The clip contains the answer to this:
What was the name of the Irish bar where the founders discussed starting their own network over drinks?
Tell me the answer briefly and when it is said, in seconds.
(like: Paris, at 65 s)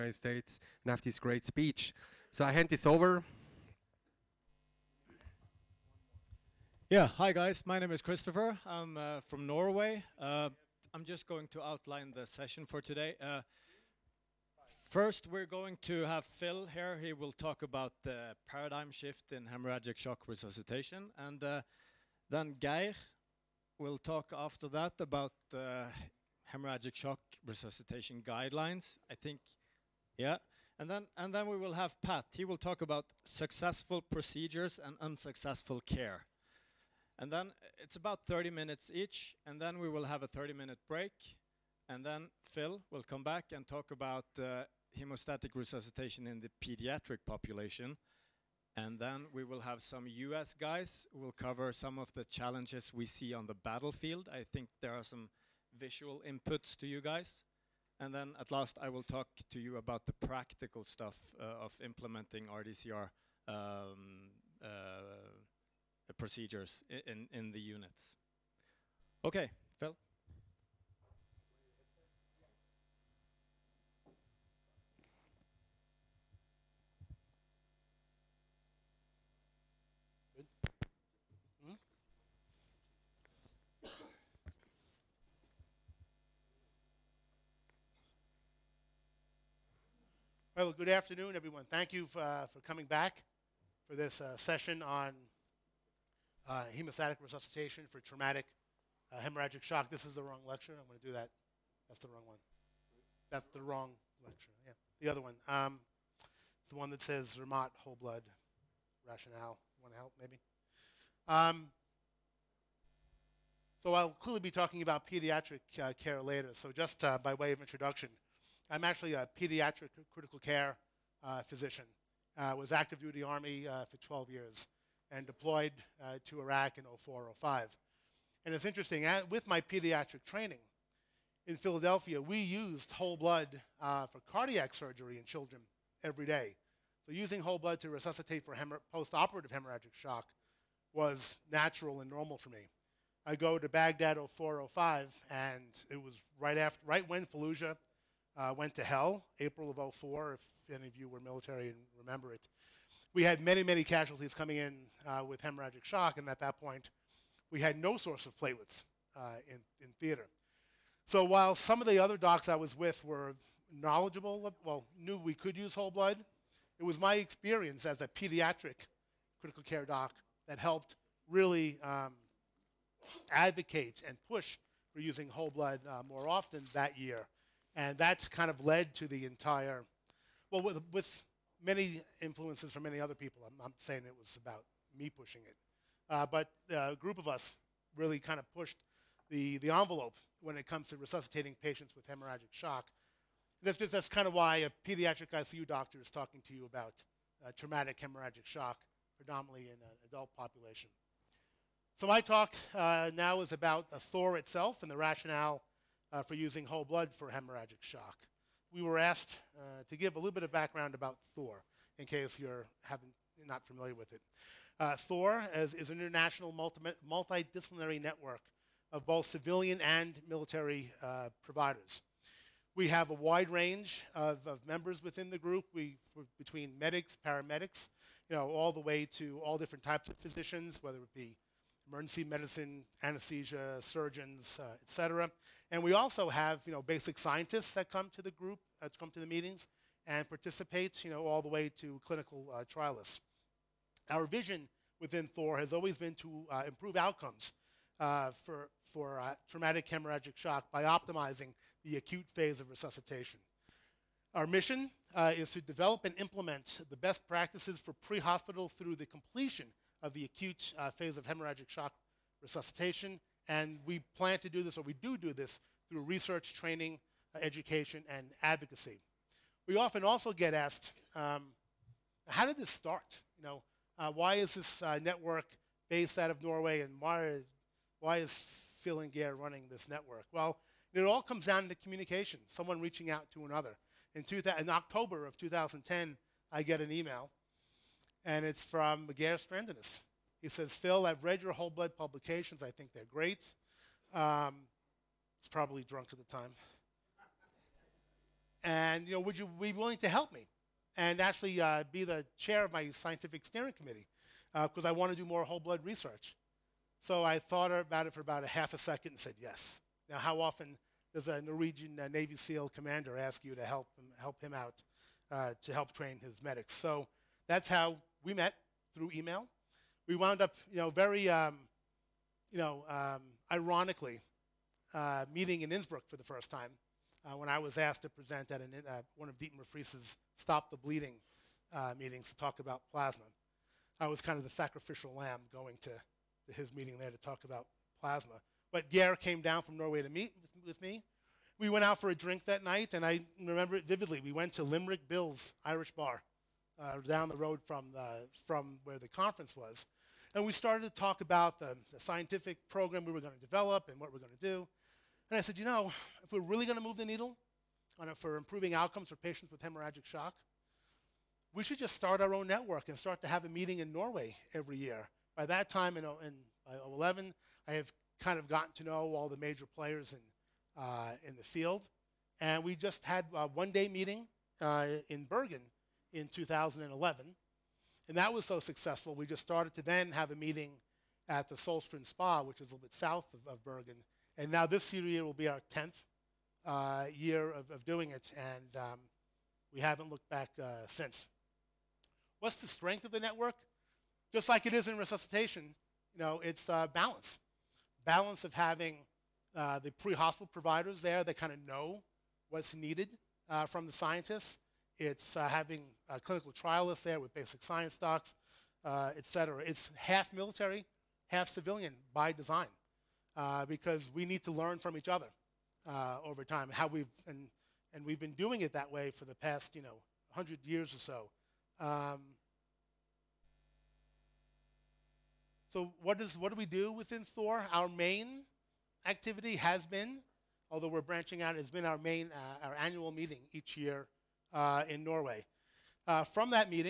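Limerick Bill's, at 344 s.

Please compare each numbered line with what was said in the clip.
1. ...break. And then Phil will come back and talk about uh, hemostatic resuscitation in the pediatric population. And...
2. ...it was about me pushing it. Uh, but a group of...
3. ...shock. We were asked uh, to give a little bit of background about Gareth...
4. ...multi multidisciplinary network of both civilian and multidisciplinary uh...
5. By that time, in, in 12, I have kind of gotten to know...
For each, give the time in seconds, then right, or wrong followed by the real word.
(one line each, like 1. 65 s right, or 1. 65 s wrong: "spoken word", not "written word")
1. 40 s right
2. 184 s right
3. 207 s wrong: "Thor", not "Gareth"
4. 216 s wrong: "military", not "multidisciplinary"
5. 365 s wrong: "11", not "12".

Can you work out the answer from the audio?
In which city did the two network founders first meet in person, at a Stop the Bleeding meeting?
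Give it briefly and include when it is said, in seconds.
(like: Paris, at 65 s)
Innsbruck, at 325 s.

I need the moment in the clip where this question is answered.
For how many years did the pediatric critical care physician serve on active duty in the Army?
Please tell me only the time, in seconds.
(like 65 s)
123 s.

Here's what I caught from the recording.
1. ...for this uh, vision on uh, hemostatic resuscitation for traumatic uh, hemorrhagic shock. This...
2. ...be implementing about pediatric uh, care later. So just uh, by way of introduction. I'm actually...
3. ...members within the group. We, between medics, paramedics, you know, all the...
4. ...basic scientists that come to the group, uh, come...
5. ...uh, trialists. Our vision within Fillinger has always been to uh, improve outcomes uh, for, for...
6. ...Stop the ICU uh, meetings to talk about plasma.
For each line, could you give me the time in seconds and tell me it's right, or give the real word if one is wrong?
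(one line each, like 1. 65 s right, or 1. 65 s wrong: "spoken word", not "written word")
1. 93 s wrong: "session", not "vision"
2. 114 s wrong: "talking", not "implementing"
3. 224 s right
4. 236 s right
5. 242 s wrong: "Thor", not "Fillinger"
6. 330 s wrong: "Bleeding", not "ICU".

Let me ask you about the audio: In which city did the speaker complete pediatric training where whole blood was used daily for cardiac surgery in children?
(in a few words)
Philadelphia.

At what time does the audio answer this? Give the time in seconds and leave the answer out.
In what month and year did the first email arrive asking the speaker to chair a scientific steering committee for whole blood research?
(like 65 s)
284 s.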